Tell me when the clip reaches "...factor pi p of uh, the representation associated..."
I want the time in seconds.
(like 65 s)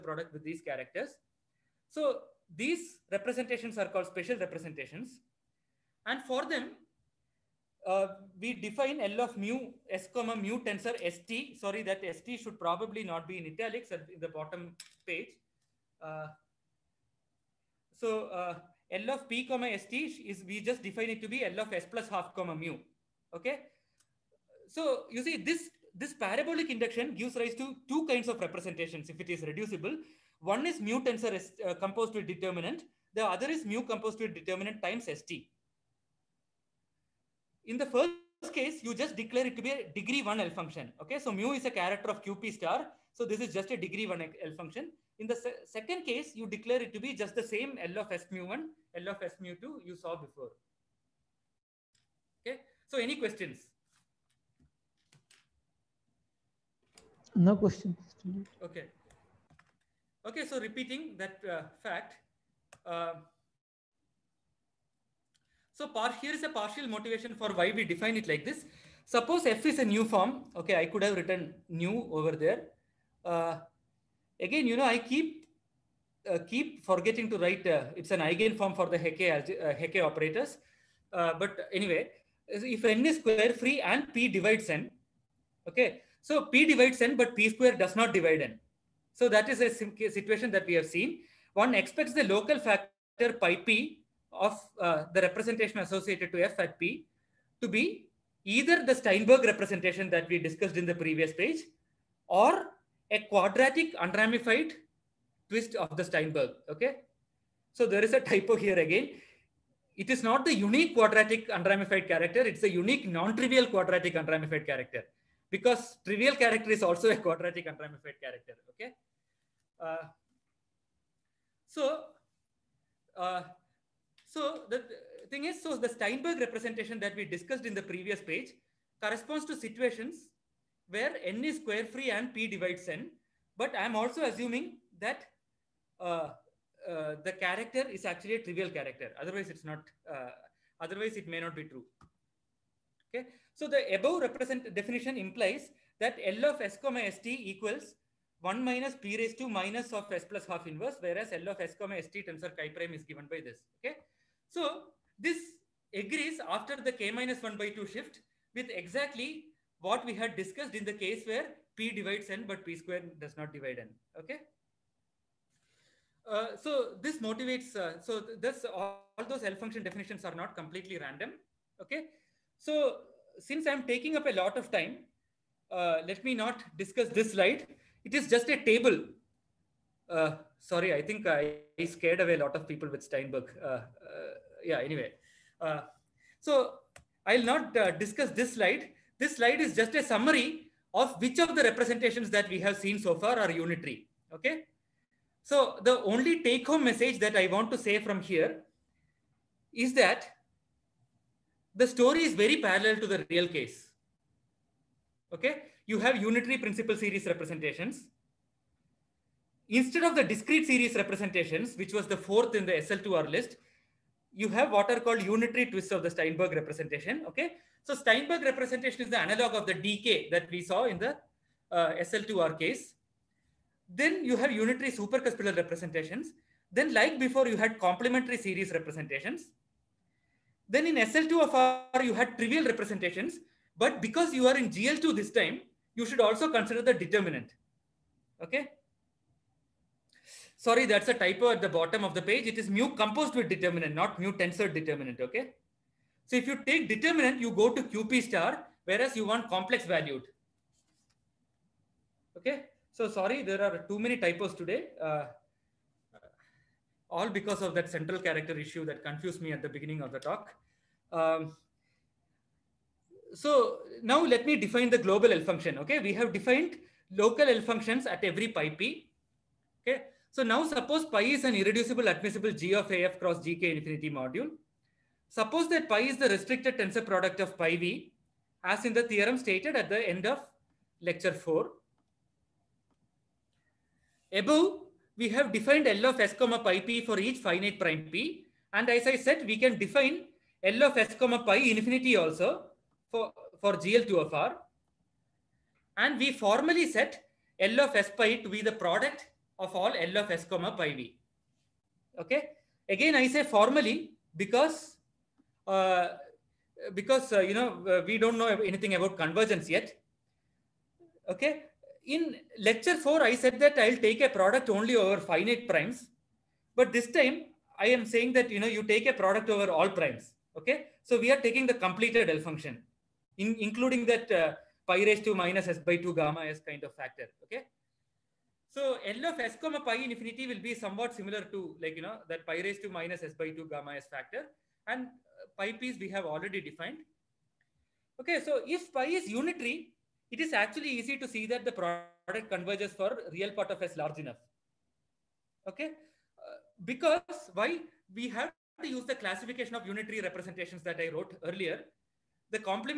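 92 s.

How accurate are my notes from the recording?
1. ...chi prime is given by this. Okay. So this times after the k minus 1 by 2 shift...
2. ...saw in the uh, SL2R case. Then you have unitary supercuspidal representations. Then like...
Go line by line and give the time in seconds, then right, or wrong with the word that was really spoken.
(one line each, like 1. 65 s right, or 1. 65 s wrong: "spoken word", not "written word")
1. 152 s wrong: "agrees", not "times"
2. 220 s right.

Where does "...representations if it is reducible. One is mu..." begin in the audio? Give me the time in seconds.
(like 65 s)
28 s.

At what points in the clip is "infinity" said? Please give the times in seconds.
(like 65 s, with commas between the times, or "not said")
273 s, 291 s, 330 s.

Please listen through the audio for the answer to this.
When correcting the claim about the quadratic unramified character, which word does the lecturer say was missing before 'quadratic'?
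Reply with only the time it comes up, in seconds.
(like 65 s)
113 s.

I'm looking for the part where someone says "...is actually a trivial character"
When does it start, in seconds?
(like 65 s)
137 s.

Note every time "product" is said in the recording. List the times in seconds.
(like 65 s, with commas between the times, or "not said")
0 s, 277 s, 298 s, 314 s, 319 s, 341 s.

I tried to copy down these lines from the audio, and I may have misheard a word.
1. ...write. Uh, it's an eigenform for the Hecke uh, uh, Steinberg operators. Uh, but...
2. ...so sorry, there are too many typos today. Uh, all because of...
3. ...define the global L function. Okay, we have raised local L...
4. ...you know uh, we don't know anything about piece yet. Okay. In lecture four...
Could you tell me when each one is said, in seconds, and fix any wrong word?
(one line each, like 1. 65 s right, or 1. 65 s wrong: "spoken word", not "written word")
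1. 77 s wrong: "Hecke", not "Steinberg"
2. 252 s right
3. 264 s wrong: "defined", not "raised"
4. 307 s wrong: "convergence", not "piece".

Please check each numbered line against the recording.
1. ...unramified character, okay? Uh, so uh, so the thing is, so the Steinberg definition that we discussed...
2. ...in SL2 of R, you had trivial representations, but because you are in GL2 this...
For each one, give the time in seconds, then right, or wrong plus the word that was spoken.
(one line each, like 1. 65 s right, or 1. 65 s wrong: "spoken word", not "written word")
1. 117 s wrong: "representation", not "definition"
2. 230 s right.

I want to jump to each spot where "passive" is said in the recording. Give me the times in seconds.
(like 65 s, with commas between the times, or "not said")
not said.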